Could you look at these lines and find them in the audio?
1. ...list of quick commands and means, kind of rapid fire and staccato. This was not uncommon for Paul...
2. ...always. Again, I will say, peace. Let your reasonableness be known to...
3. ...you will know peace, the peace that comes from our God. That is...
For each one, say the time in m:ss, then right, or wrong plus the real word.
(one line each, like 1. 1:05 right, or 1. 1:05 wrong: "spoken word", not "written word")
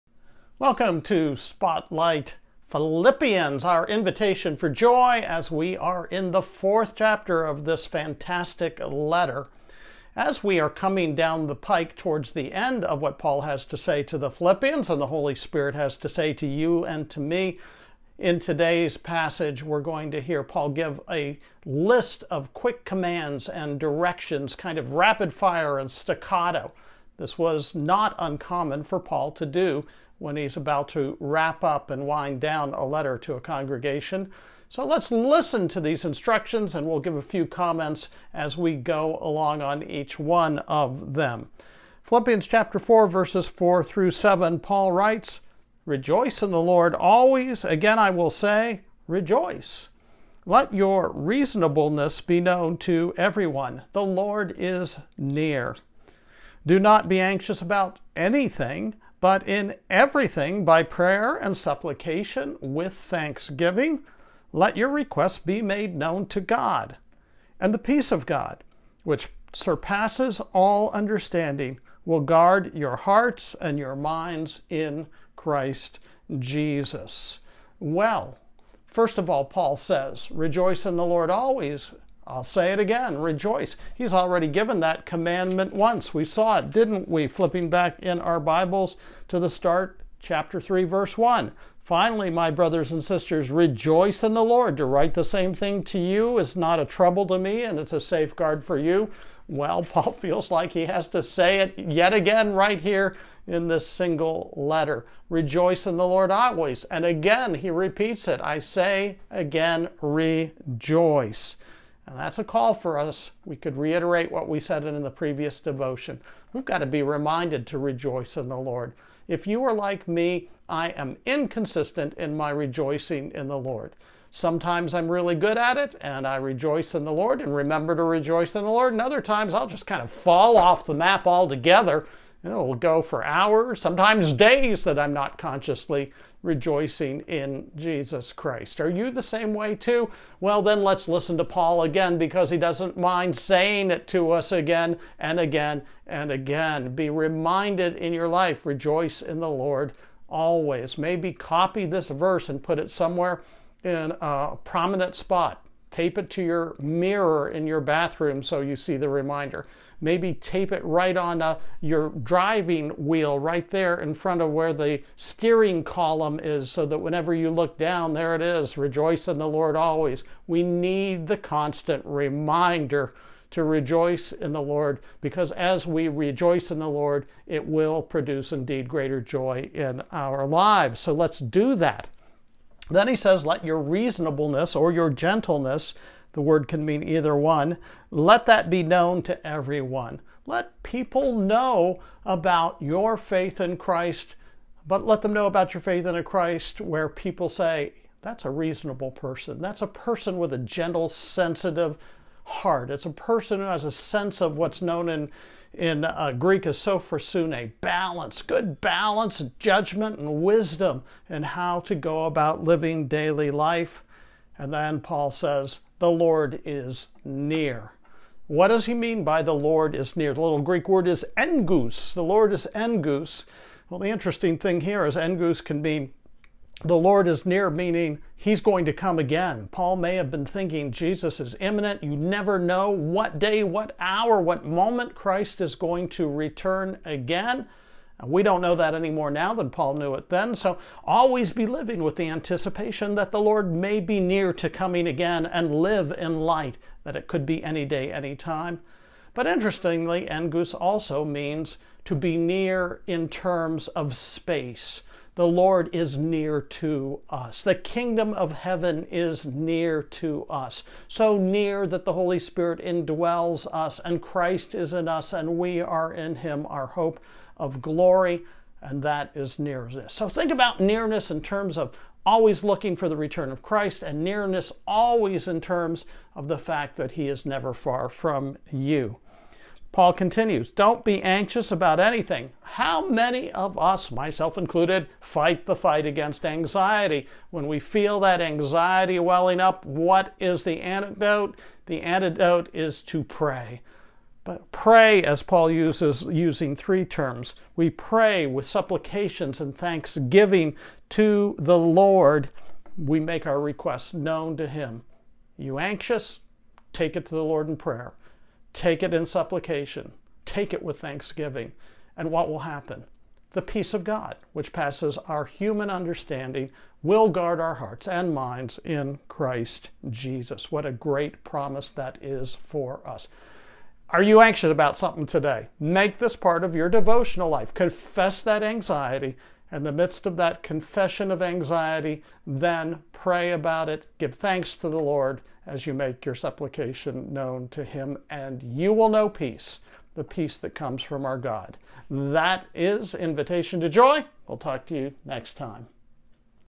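1. 0:21 wrong: "directions", not "means"
2. 0:46 wrong: "rejoice", not "peace"
3. 5:38 right.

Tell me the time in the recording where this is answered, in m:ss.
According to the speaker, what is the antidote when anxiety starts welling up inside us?
4:53.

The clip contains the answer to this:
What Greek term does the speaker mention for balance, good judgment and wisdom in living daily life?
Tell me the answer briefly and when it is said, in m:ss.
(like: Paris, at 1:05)
Sophrosune, at 3:26.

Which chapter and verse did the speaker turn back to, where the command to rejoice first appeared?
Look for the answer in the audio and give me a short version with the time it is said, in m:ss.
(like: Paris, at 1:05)
Chapter 3, verse 1, at 1:30.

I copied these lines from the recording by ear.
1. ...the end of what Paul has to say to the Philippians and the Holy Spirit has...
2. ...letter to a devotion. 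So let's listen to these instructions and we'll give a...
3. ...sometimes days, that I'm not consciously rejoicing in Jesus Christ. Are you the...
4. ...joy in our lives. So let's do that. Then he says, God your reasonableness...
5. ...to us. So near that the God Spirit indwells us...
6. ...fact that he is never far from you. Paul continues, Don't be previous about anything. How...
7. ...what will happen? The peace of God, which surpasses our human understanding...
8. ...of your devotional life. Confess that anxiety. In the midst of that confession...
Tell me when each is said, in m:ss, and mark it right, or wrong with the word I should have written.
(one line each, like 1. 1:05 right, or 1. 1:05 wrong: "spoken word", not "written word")
1. 0:12 right
2. 0:32 wrong: "congregation", not "devotion"
3. 2:13 right
4. 2:59 wrong: "Let", not "God"
5. 4:20 wrong: "Holy", not "God"
6. 4:36 wrong: "anxious", not "previous"
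7. 5:12 wrong: "passes", not "surpasses"
8. 5:26 right.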